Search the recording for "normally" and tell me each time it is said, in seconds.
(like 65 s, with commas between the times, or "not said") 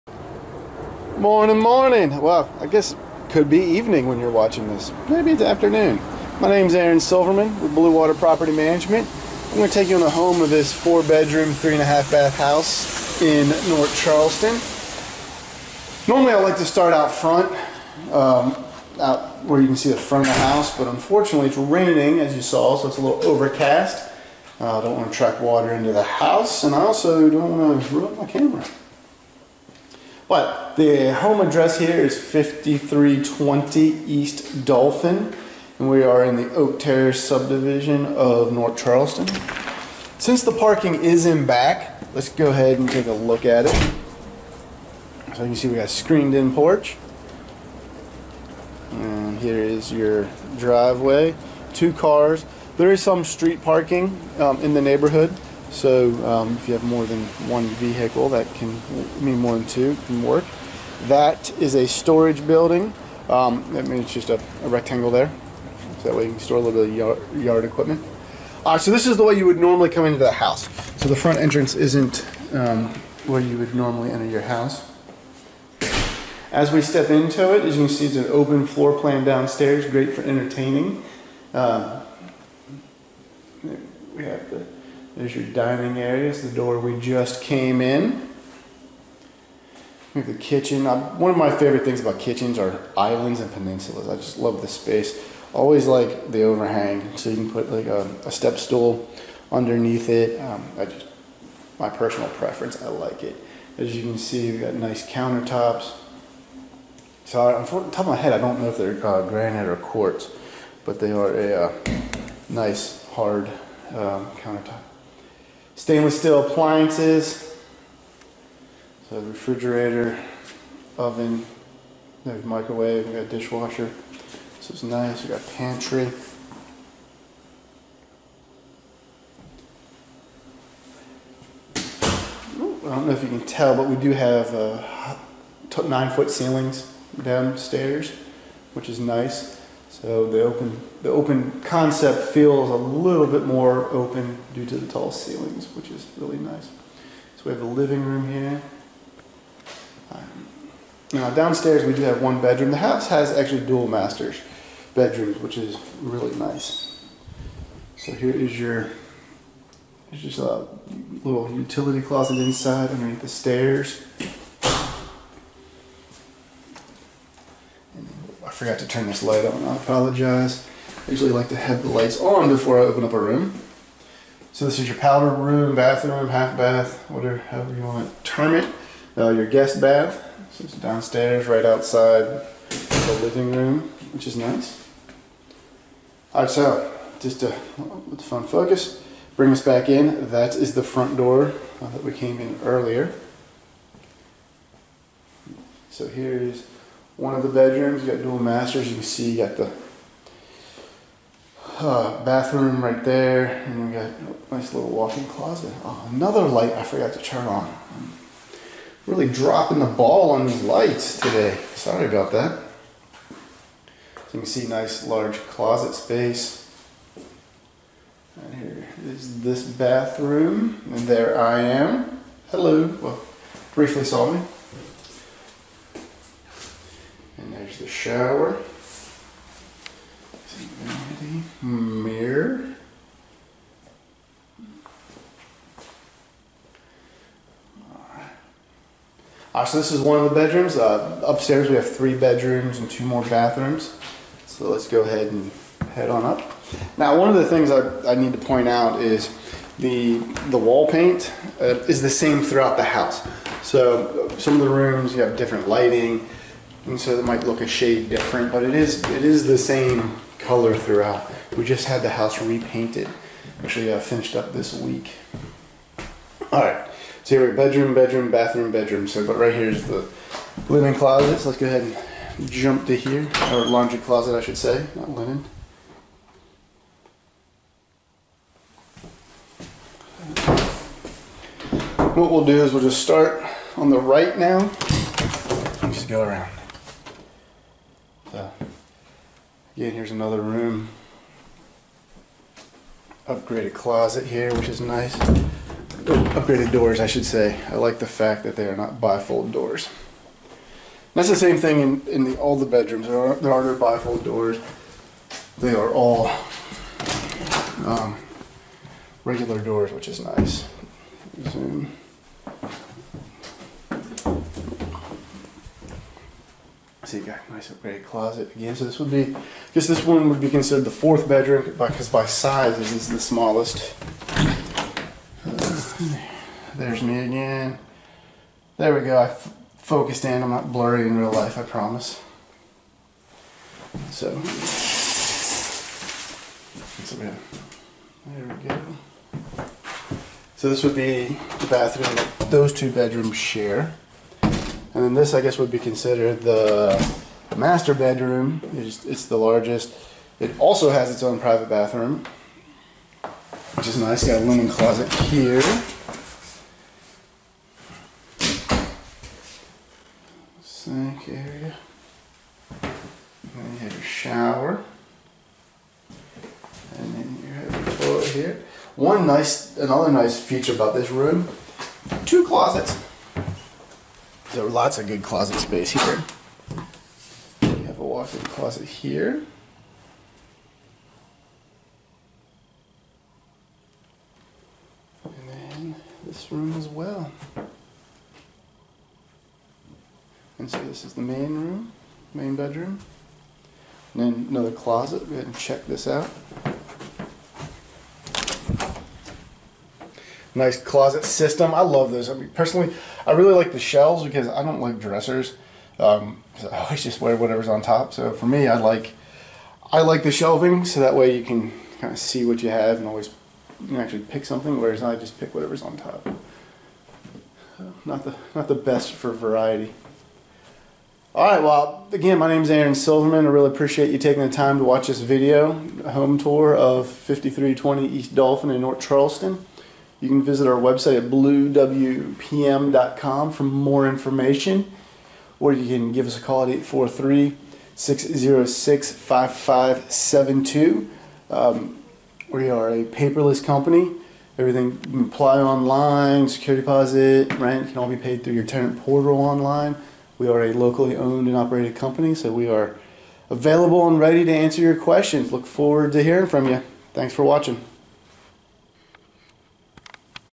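16 s, 69 s, 73 s.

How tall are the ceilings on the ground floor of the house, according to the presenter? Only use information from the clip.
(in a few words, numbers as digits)
9 feet.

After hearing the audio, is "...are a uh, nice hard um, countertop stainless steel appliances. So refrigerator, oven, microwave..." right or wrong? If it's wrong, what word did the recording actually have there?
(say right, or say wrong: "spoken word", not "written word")
right.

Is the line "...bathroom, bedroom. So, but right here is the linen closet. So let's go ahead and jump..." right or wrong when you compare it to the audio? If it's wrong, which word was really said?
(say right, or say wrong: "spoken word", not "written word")
right.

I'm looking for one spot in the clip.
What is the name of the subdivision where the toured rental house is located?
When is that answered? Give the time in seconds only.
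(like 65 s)
36 s.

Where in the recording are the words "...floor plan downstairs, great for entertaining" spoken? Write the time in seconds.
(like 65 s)
78 s.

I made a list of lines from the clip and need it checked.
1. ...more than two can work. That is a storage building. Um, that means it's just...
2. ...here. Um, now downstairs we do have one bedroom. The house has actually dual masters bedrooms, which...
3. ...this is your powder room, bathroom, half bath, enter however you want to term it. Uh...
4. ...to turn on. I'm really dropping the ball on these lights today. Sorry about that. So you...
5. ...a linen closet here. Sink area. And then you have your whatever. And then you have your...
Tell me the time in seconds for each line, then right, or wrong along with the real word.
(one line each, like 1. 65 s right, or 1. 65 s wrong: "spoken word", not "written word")
1. 59 s right
2. 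148 s right
3. 174 s wrong: "whatever", not "enter"
4. 207 s right
5. 354 s wrong: "shower", not "whatever".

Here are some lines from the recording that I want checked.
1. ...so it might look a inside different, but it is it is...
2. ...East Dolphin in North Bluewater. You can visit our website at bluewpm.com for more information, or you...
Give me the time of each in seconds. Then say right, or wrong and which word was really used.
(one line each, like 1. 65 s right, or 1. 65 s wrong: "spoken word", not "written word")
1. 256 s wrong: "shade", not "inside"
2. 428 s wrong: "Charleston", not "Bluewater".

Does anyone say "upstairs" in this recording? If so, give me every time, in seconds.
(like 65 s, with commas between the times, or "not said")
241 s.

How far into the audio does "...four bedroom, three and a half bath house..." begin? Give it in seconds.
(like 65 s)
10 s.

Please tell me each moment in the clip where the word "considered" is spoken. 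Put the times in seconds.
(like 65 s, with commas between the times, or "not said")
320 s, 345 s.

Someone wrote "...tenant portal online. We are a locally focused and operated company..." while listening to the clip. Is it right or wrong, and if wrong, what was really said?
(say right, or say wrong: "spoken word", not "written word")
wrong: "owned", not "focused".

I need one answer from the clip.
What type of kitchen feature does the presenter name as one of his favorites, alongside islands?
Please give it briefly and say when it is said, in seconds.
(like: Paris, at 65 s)
peninsulas, at 93 s.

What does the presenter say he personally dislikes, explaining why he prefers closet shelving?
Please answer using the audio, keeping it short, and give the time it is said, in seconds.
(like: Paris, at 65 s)
dressers, at 404 s.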